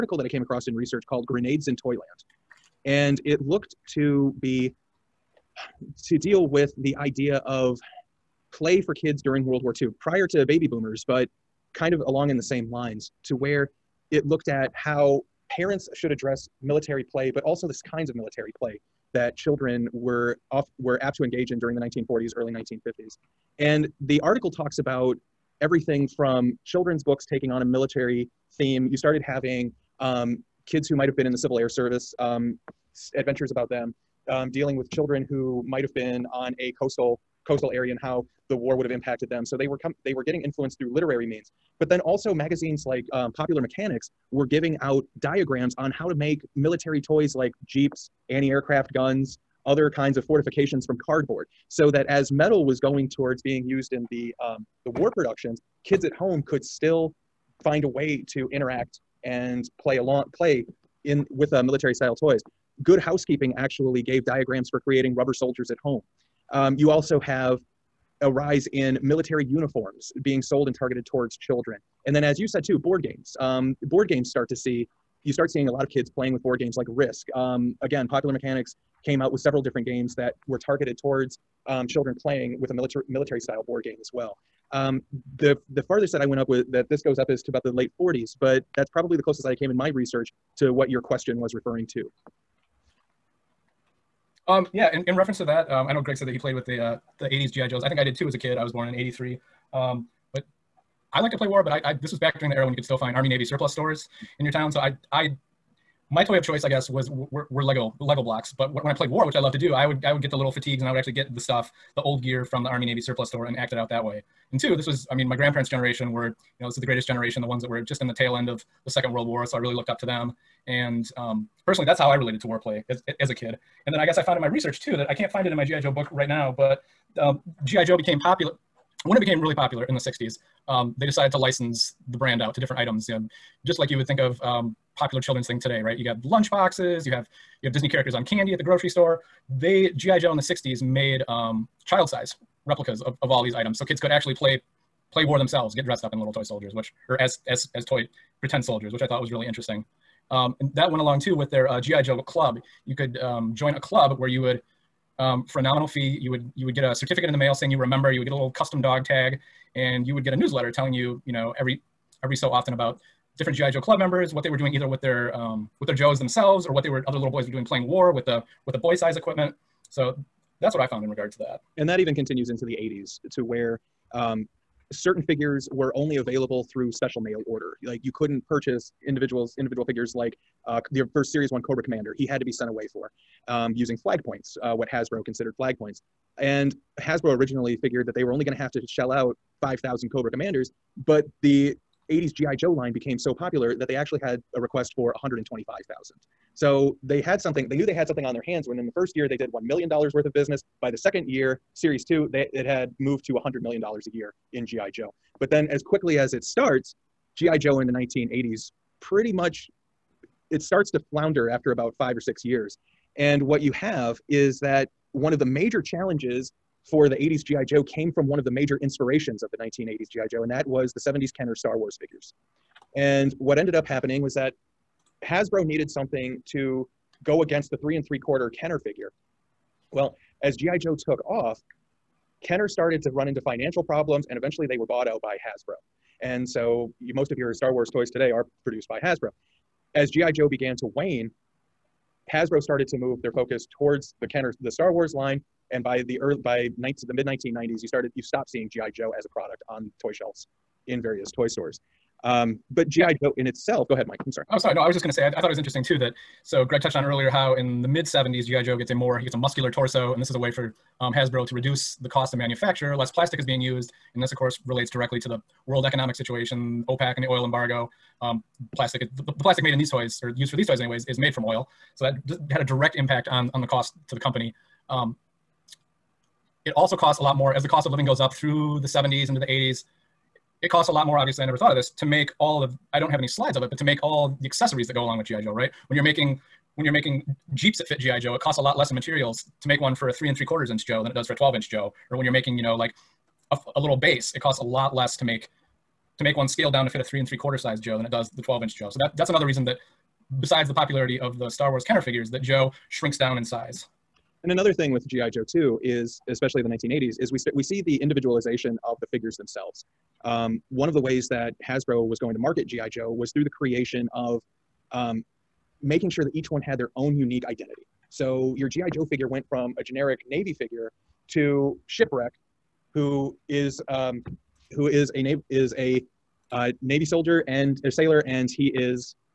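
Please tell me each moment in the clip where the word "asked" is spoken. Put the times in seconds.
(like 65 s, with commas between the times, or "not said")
not said.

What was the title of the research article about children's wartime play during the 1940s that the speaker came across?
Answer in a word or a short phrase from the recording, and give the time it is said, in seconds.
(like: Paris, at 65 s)
Grenades in Toyland, at 1 s.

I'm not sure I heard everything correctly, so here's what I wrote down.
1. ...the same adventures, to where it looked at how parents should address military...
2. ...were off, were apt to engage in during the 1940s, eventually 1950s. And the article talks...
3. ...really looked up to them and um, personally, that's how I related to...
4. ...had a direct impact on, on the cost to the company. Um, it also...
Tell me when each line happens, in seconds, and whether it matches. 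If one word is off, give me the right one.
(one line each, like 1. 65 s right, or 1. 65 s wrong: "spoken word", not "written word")
1. 12 s wrong: "lines", not "adventures"
2. 19 s wrong: "early", not "eventually"
3. 119 s right
4. 272 s right.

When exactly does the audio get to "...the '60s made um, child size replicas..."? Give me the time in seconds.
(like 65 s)
140 s.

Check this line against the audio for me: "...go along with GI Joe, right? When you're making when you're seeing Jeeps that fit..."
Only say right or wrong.
wrong.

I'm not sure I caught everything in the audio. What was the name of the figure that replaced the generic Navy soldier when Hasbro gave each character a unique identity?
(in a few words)
Shipwreck.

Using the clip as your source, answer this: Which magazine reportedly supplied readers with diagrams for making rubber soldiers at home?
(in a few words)
Good Housekeeping.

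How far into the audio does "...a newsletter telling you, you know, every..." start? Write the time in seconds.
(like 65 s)
160 s.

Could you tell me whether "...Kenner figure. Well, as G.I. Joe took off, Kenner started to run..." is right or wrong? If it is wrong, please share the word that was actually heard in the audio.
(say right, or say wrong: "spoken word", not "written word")
right.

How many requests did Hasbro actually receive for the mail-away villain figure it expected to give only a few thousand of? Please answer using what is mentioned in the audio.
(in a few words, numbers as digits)
125,000.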